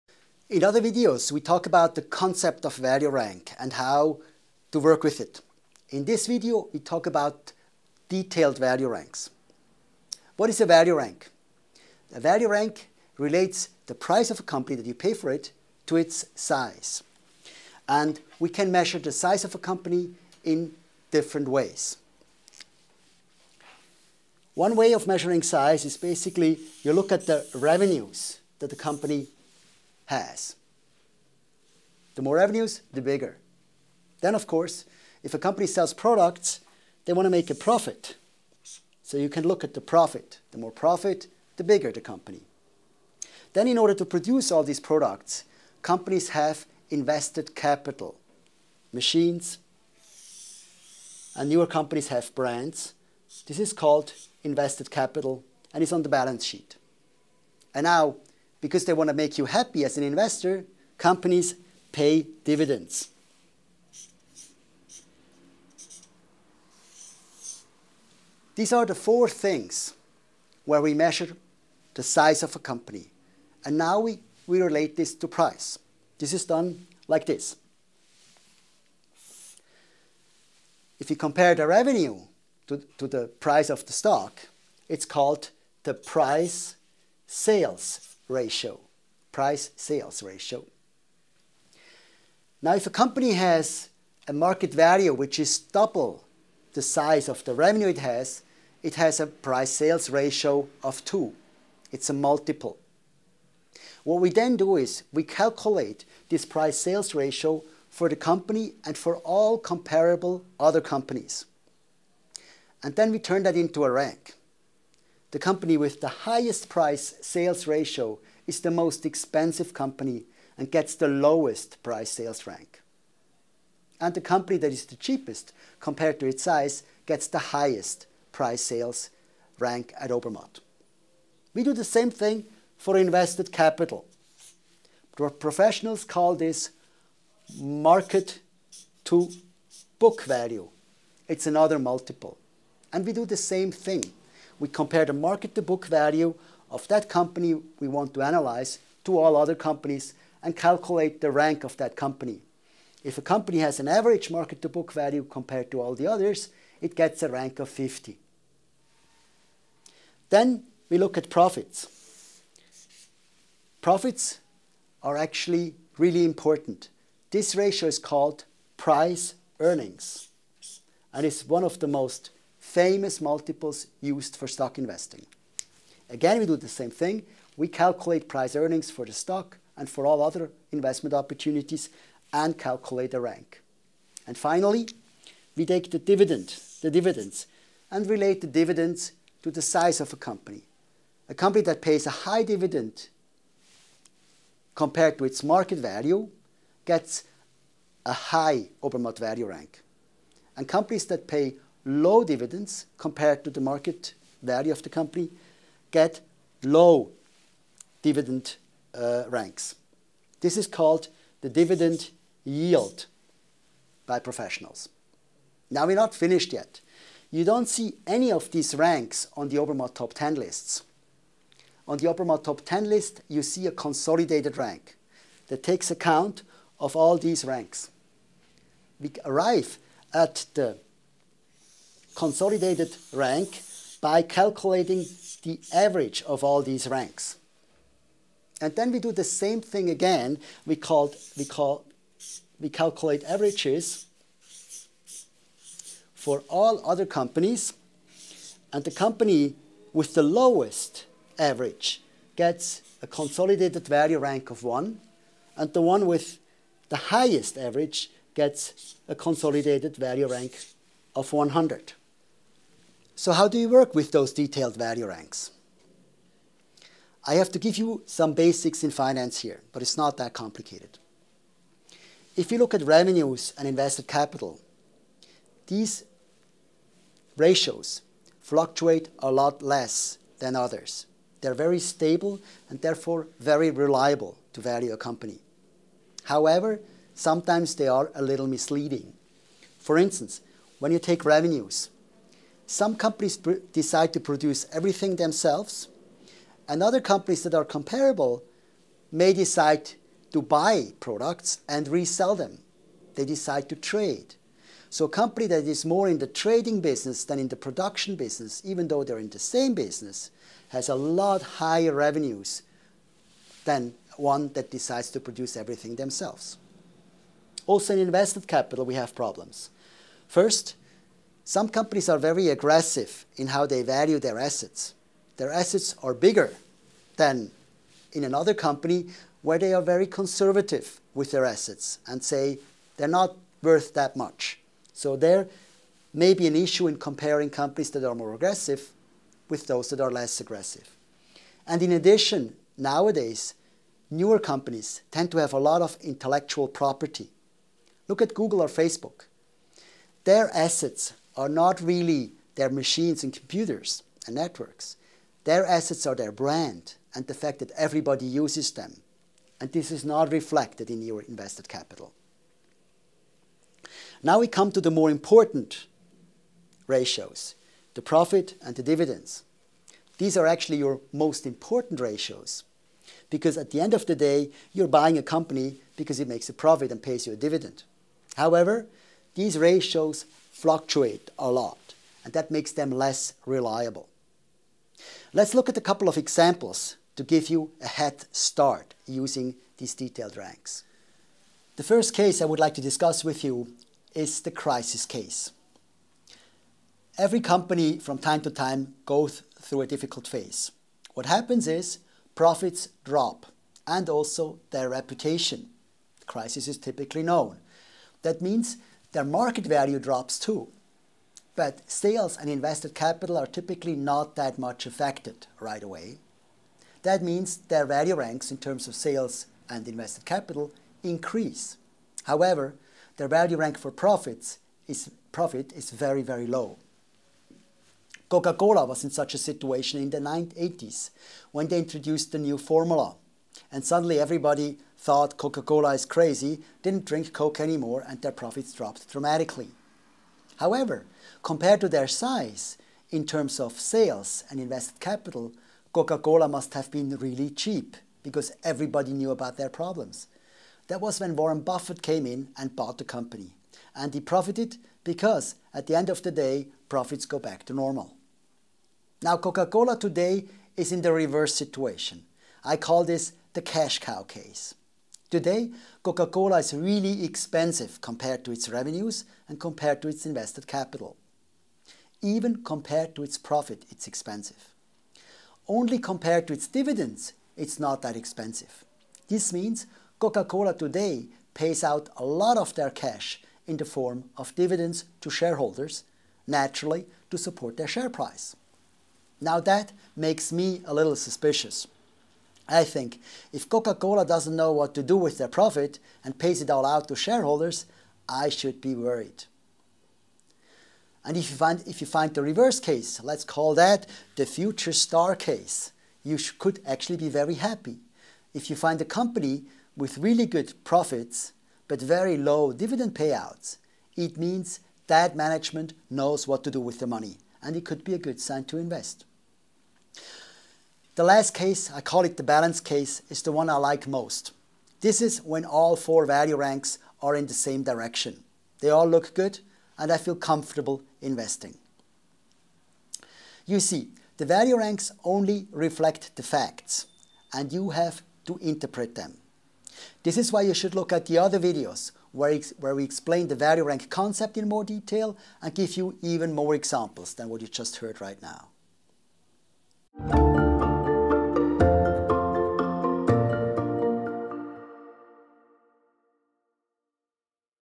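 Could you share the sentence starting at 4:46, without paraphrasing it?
However, sometimes they are a little misleading.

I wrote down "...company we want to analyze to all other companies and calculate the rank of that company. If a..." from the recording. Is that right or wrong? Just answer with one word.
right.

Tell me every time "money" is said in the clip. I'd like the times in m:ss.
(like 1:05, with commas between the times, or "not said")
8:37.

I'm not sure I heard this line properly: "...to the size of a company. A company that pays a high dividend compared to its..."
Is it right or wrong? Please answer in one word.
right.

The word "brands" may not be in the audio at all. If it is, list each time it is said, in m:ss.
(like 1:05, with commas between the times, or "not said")
0:52, 5:56.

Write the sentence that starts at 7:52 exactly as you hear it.
Even compared to its profit, it's expensive.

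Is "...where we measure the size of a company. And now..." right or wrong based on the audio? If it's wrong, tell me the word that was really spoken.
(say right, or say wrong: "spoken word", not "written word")
right.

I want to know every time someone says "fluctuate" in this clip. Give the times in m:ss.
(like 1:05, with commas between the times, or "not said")
4:38, 6:20.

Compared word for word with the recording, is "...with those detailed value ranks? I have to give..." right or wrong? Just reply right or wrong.
right.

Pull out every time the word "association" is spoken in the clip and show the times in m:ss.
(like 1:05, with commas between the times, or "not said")
not said.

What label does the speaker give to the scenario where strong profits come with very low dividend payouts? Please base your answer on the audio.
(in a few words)
future star case.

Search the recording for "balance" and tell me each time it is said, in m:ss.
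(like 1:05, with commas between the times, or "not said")
0:56, 8:42.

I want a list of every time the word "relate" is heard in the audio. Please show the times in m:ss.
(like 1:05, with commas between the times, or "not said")
0:13, 1:14, 3:08.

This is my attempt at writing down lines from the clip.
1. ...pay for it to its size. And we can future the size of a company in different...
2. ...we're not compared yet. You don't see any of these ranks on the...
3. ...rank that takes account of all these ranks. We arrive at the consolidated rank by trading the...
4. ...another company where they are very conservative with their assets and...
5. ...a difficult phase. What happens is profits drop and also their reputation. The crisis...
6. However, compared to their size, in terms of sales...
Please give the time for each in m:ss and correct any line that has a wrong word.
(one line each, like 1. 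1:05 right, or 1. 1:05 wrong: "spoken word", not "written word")
1. 0:14 wrong: "measure", not "future"
2. 3:35 wrong: "finished", not "compared"
3. 3:44 wrong: "calculating", not "trading"
4. 5:28 right
5. 6:39 right
6. 7:20 right.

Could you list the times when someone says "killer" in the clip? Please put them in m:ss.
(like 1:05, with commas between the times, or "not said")
not said.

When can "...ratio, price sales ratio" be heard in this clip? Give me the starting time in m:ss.
1:28.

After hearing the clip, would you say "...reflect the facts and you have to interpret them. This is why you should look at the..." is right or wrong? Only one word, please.
right.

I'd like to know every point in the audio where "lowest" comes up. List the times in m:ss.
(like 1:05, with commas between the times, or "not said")
2:01, 4:10.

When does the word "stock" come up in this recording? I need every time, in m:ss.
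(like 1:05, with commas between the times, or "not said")
1:23, 2:54, 2:59.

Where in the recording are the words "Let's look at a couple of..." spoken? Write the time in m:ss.
6:25.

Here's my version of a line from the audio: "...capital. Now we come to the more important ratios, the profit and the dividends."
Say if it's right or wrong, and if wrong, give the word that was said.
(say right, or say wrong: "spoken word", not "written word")
right.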